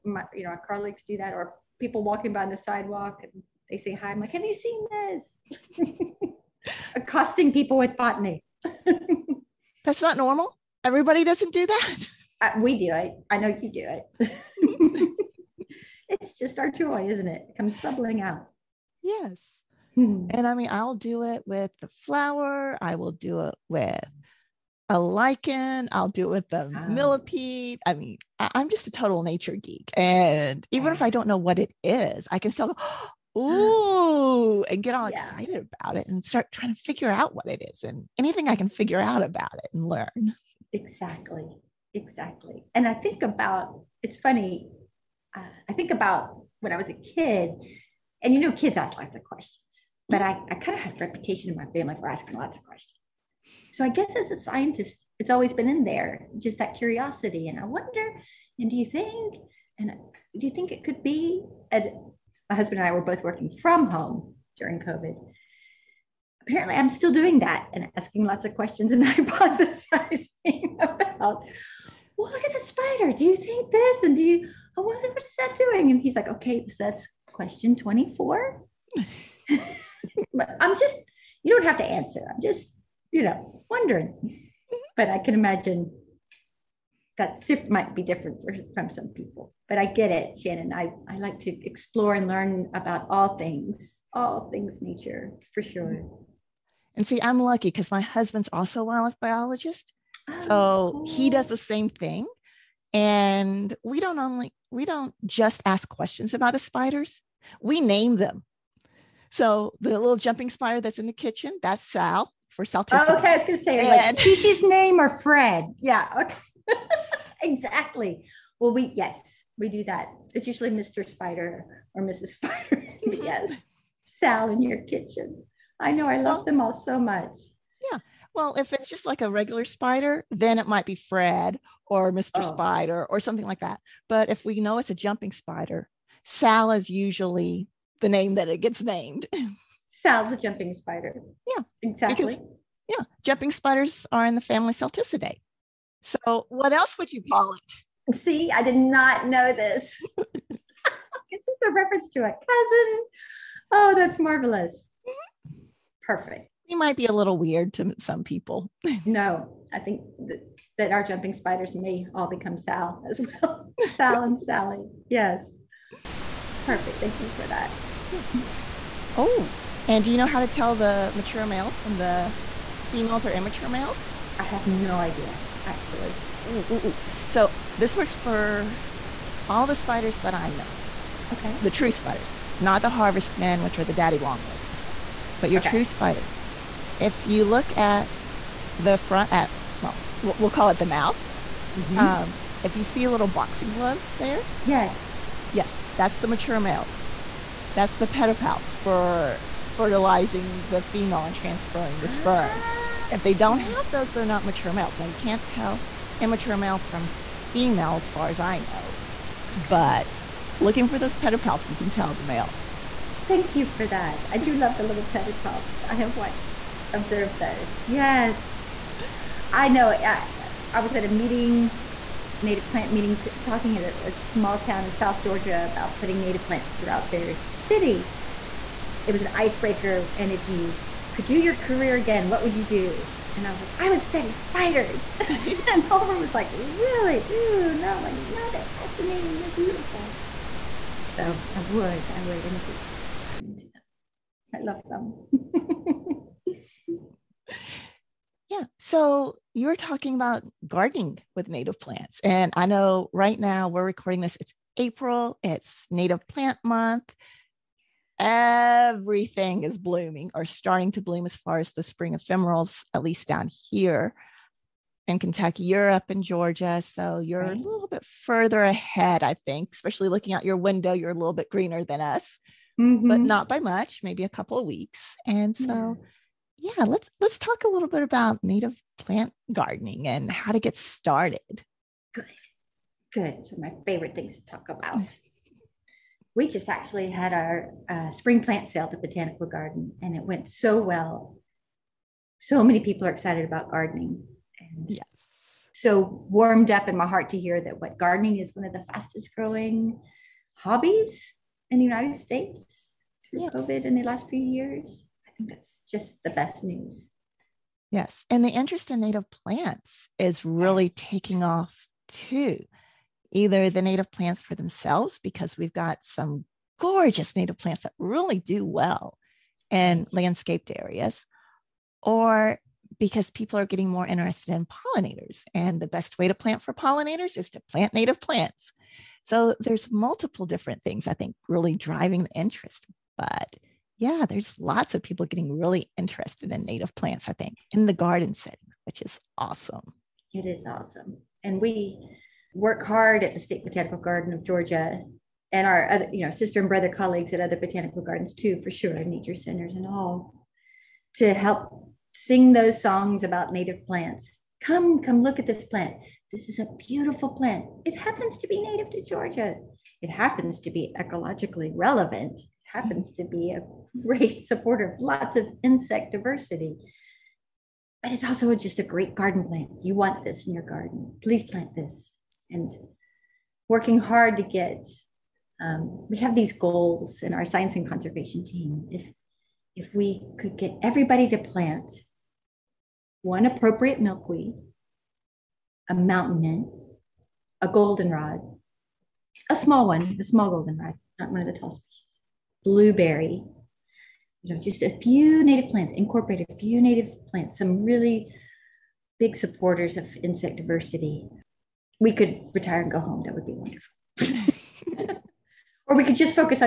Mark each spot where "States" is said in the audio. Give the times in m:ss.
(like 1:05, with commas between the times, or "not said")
5:02, 5:43.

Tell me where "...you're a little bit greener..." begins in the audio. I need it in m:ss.
4:30.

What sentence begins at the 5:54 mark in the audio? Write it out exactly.
Come, come look at this plant.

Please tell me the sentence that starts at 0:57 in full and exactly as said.
And I wonder, and do you think, and do you think it could be?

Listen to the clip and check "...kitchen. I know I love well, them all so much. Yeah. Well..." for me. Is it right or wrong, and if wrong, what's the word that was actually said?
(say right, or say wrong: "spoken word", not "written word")
right.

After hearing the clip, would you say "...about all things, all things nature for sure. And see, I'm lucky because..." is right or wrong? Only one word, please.
right.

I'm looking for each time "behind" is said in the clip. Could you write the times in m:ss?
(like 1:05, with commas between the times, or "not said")
not said.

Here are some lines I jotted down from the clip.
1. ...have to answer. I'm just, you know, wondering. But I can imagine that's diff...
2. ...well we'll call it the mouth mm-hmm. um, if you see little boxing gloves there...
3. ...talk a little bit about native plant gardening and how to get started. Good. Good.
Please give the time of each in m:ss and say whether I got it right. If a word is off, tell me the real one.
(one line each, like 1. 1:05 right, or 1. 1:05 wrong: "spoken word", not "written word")
1. 1:21 right
2. 3:09 right
3. 4:37 right.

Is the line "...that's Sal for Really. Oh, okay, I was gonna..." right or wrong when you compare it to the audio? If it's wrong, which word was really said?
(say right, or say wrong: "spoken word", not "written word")
wrong: "Salticidae", not "Really".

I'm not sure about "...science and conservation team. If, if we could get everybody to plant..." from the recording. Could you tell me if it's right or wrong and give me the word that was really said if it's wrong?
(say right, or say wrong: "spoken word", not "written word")
right.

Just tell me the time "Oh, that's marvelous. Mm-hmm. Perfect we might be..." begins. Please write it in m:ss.
2:33.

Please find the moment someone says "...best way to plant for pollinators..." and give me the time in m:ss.
5:25.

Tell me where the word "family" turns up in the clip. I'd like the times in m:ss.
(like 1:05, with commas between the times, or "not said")
0:51, 2:24.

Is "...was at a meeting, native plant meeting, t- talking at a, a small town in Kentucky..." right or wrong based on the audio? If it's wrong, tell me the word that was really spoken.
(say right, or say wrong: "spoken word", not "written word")
wrong: "South", not "Kentucky".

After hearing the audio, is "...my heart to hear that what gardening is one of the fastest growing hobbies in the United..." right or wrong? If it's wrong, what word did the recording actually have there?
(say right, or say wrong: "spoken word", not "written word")
right.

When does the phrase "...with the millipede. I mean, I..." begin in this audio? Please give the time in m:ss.
0:26.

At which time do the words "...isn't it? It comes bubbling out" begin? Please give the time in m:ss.
0:17.